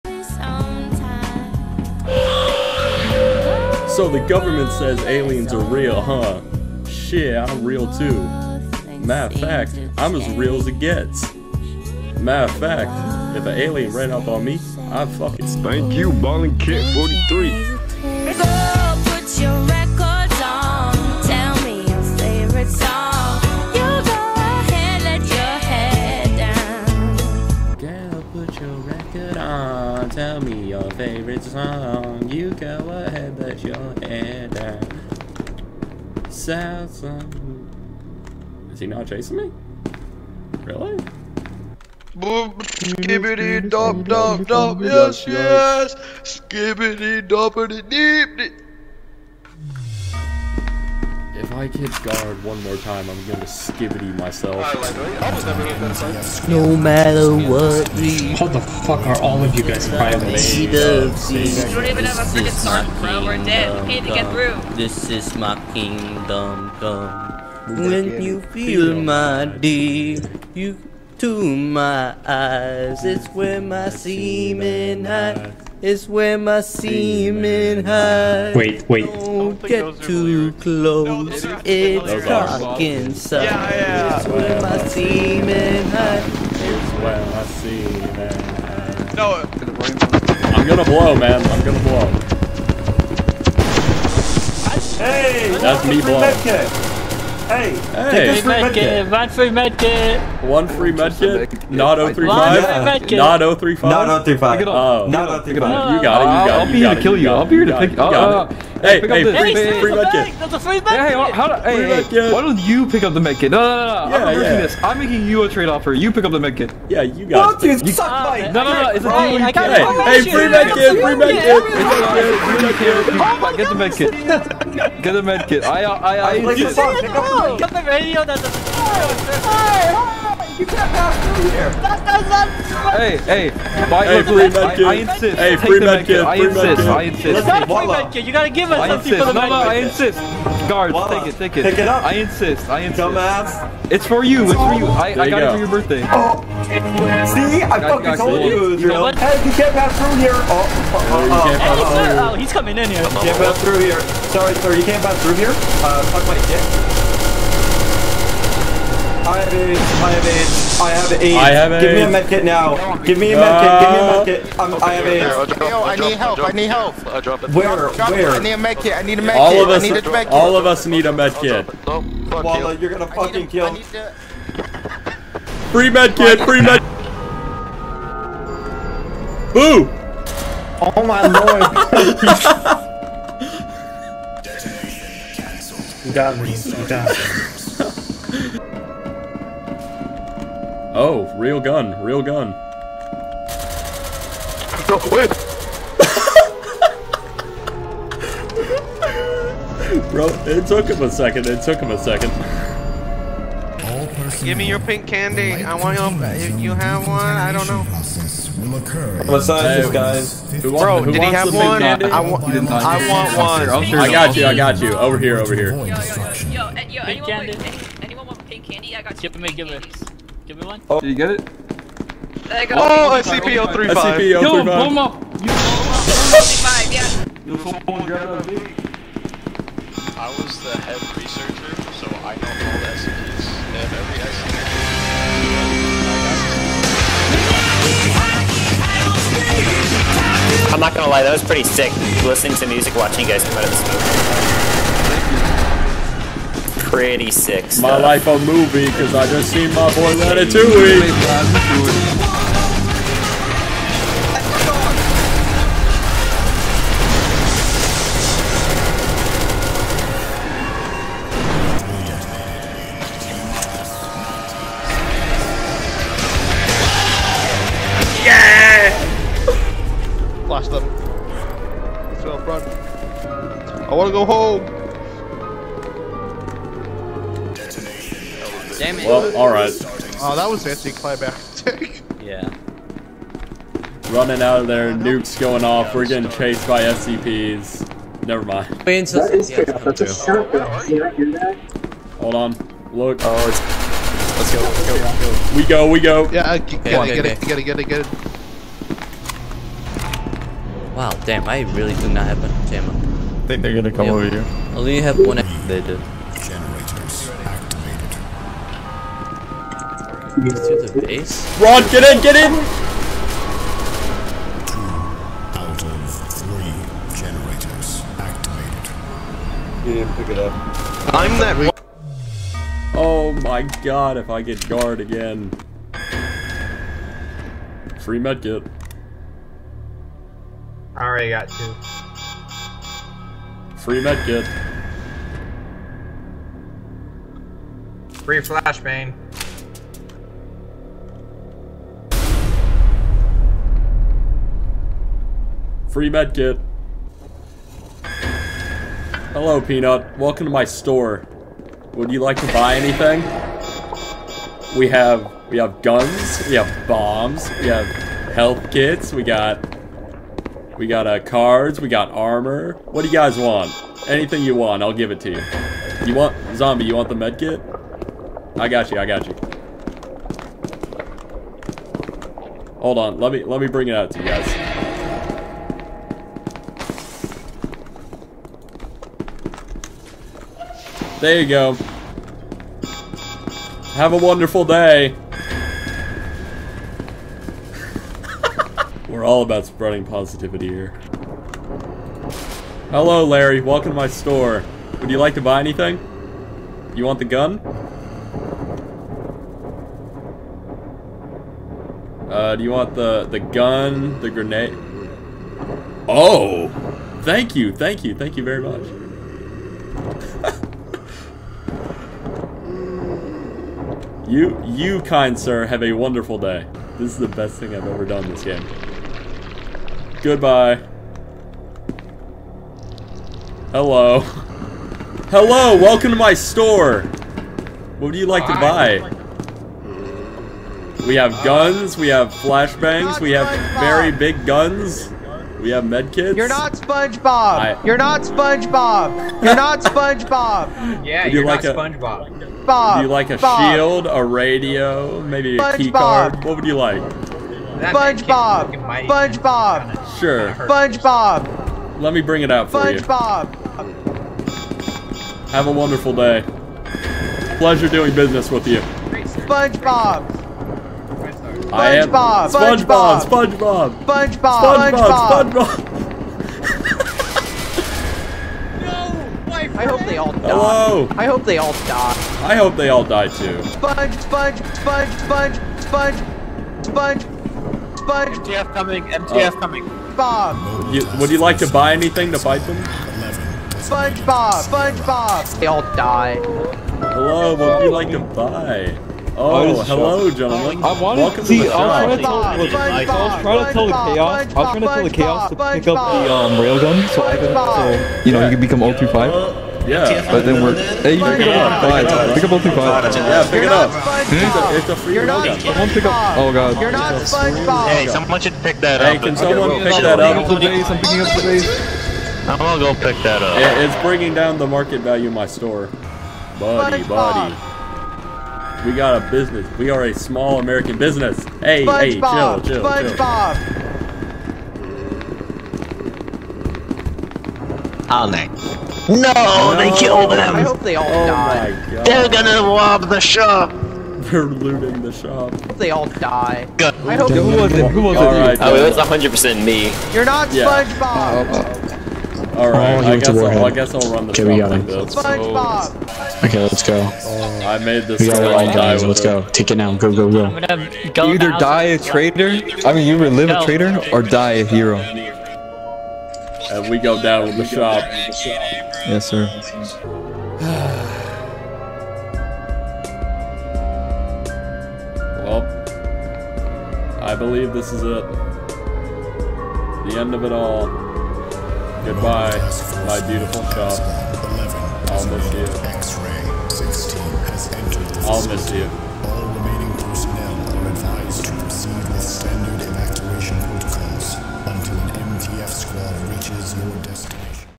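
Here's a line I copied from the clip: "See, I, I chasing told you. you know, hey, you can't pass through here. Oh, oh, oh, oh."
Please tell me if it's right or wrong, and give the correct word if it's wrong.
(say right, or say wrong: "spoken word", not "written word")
wrong: "fucking", not "chasing".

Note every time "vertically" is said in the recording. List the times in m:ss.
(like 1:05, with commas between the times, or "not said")
not said.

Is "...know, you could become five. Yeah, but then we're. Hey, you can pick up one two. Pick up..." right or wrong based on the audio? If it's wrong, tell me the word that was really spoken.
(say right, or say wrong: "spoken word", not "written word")
wrong: "five", not "two".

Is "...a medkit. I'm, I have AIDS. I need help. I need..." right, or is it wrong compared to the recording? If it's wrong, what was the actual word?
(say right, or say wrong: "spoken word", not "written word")
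right.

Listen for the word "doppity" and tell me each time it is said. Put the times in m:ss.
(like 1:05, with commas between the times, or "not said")
0:47.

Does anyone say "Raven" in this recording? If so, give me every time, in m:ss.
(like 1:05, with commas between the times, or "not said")
not said.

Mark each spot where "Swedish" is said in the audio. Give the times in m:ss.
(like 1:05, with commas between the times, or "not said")
not said.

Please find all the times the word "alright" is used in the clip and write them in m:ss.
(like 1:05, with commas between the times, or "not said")
4:39.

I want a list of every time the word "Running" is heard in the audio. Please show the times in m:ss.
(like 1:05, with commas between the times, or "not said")
4:44.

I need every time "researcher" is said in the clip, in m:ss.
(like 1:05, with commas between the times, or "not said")
3:51.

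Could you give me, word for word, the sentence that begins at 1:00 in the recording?
You don't even have a freaking bro.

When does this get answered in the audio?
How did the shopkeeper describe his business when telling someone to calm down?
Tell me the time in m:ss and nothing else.
8:40.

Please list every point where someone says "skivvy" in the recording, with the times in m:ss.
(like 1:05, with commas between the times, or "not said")
0:53.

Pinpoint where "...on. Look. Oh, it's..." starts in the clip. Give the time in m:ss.
4:52.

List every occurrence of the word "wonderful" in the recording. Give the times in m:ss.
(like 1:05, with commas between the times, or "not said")
6:24, 6:55, 7:35.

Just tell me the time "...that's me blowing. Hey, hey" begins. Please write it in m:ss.
1:35.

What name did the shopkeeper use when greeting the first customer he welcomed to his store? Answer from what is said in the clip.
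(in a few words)
Peanut.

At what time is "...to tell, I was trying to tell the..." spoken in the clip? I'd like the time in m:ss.
8:12.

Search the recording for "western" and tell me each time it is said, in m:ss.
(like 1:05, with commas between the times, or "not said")
not said.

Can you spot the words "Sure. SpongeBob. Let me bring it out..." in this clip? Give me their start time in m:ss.
7:30.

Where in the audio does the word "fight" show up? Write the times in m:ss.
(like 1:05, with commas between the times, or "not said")
8:02.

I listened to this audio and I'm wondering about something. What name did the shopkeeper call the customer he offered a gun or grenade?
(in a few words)
Larry.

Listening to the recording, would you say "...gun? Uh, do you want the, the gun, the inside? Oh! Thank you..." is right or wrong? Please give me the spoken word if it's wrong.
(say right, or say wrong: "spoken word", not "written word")
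wrong: "grenade", not "inside".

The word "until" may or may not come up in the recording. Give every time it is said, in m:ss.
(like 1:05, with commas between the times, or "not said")
4:49, 9:44.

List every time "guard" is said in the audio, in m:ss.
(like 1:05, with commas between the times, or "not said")
0:52, 2:20, 5:24.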